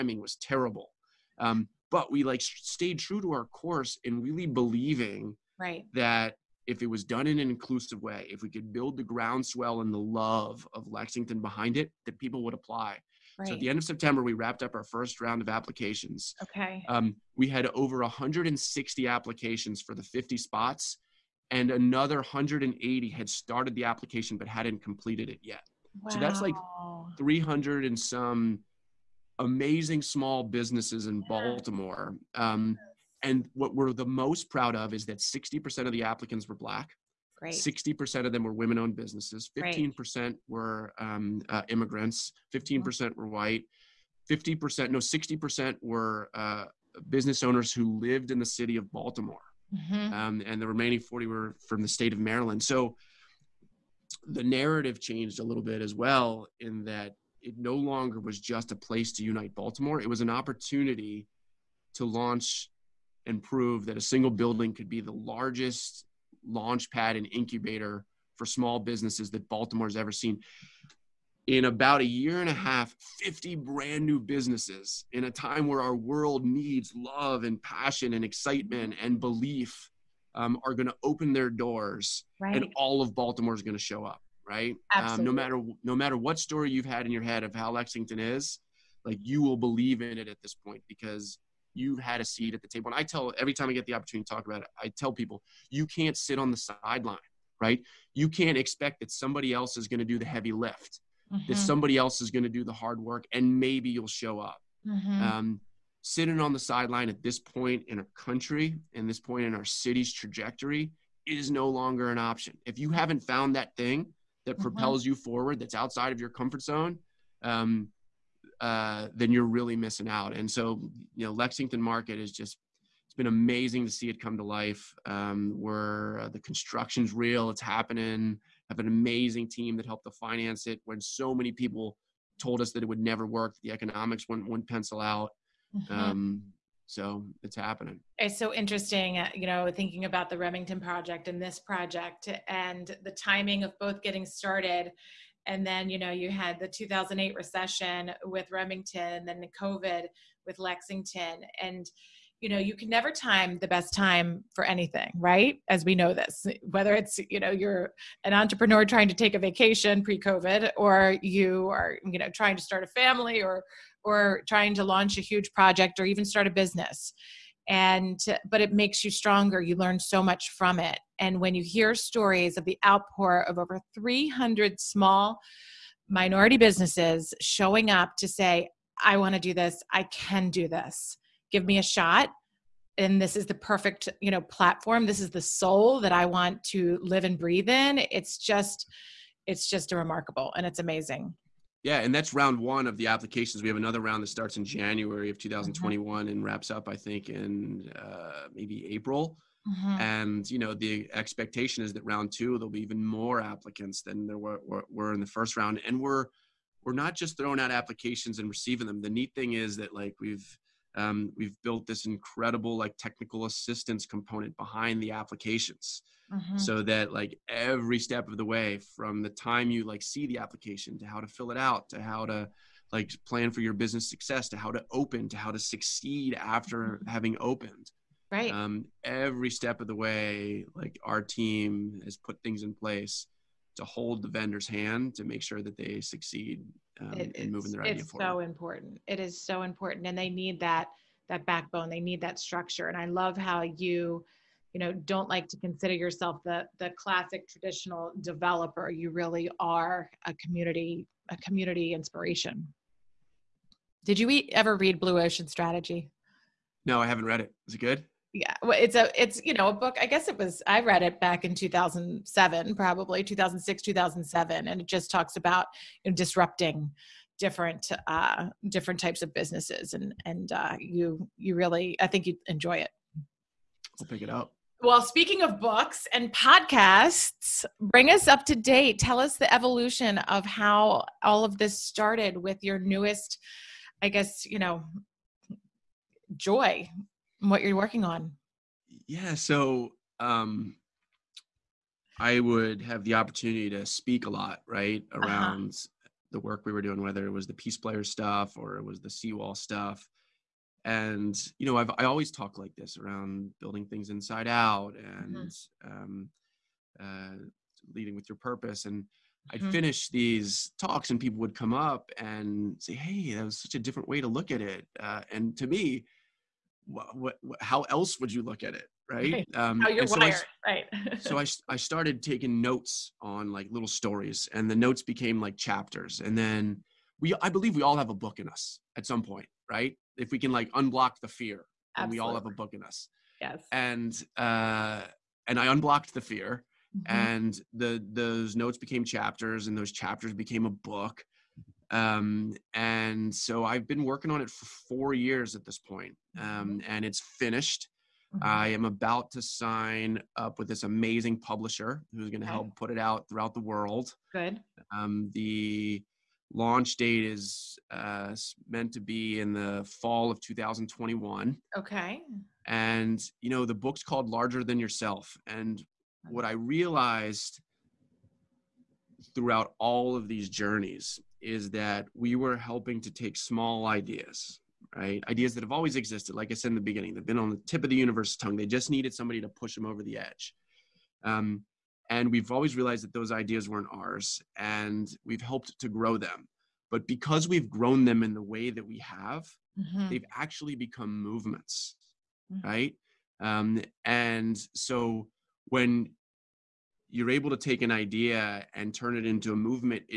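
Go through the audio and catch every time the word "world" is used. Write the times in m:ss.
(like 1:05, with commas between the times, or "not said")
1:15, 5:53.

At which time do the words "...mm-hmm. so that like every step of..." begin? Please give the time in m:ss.
3:36.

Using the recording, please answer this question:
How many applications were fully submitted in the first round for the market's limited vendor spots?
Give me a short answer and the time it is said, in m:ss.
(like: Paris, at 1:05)
over 160, at 0:17.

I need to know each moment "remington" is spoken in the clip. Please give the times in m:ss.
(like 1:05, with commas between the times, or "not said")
2:20, 2:28.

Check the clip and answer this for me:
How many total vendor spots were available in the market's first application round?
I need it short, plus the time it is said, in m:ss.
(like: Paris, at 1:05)
50, at 0:19.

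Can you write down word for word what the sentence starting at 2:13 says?
The economics wouldn't, wouldn't pencil out.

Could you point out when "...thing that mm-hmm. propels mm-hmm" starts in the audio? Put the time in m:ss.
1:53.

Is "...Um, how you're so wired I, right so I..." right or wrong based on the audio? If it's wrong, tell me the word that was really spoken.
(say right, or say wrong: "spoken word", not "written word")
right.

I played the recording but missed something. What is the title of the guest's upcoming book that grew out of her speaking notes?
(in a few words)
Larger Than Yourself.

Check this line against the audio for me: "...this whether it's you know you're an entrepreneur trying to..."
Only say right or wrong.
right.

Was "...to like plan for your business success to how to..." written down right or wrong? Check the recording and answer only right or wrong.
right.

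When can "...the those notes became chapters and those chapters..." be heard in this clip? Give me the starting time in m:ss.
5:37.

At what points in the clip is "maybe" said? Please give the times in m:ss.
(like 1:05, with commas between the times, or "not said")
1:43, 3:18.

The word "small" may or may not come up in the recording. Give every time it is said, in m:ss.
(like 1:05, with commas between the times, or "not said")
0:30, 1:08, 2:54, 6:13.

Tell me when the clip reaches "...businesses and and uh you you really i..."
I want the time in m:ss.
4:29.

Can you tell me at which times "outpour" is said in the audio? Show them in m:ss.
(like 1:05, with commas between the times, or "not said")
2:52.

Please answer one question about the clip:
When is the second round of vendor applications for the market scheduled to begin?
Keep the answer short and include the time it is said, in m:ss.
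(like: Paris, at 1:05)
January 2021, at 3:14.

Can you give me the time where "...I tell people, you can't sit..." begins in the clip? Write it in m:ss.
1:34.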